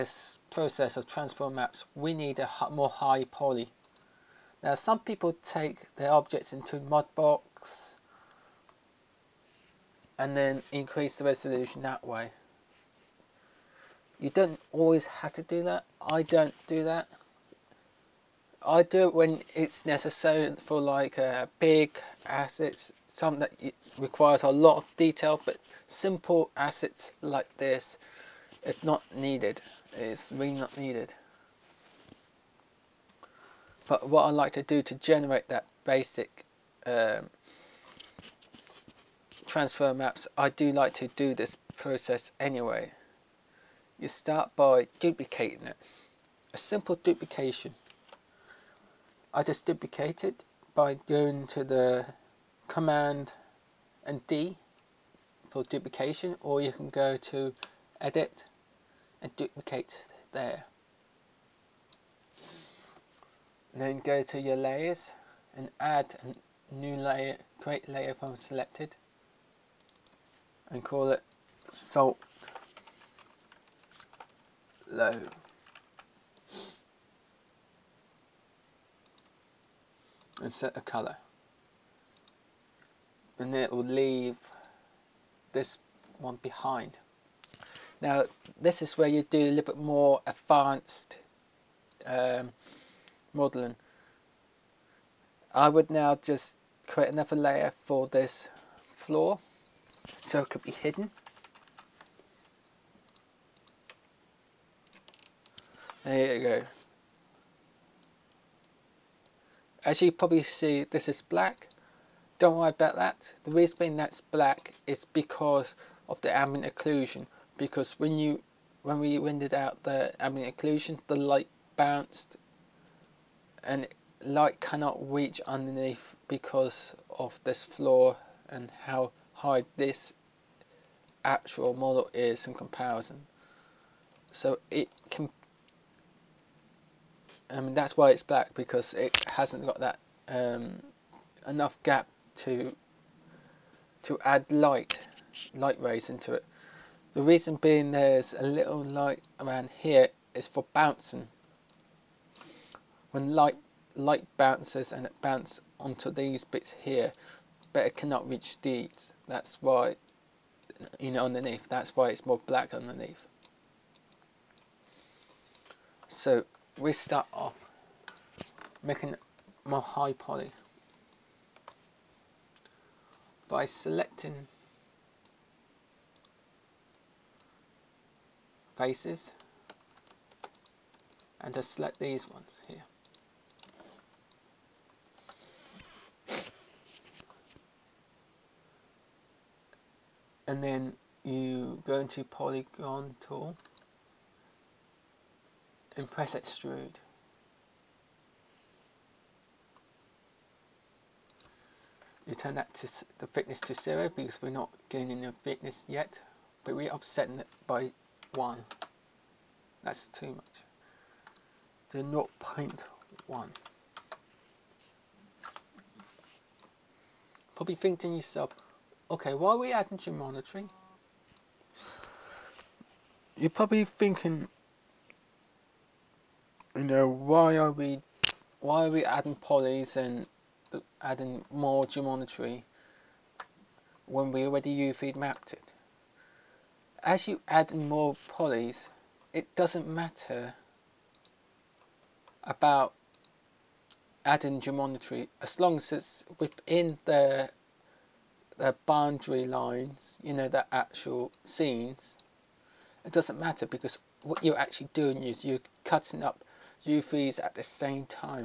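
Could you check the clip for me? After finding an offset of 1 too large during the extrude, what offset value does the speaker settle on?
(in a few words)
0.1.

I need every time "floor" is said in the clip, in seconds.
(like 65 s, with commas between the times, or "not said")
98 s, 127 s.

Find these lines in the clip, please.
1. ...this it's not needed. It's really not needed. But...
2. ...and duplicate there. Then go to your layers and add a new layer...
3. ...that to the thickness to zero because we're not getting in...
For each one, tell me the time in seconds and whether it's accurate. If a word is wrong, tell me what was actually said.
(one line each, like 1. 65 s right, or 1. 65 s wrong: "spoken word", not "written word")
1. 27 s right
2. 59 s right
3. 202 s right.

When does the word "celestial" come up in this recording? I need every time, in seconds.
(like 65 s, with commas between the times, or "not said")
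not said.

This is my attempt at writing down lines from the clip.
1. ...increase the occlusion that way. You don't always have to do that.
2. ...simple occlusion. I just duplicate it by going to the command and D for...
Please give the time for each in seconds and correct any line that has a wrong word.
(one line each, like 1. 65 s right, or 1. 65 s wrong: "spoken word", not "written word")
1. 10 s wrong: "resolution", not "occlusion"
2. 46 s wrong: "duplication", not "occlusion".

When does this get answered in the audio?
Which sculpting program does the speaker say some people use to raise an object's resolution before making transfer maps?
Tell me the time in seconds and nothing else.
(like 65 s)
6 s.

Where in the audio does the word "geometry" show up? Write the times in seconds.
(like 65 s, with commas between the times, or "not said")
219 s, 231 s, 244 s.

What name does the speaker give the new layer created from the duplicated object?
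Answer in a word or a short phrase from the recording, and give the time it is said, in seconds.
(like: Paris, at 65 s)
salt low, at 71 s.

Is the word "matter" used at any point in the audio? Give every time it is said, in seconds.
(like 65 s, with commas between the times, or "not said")
239 s, 253 s.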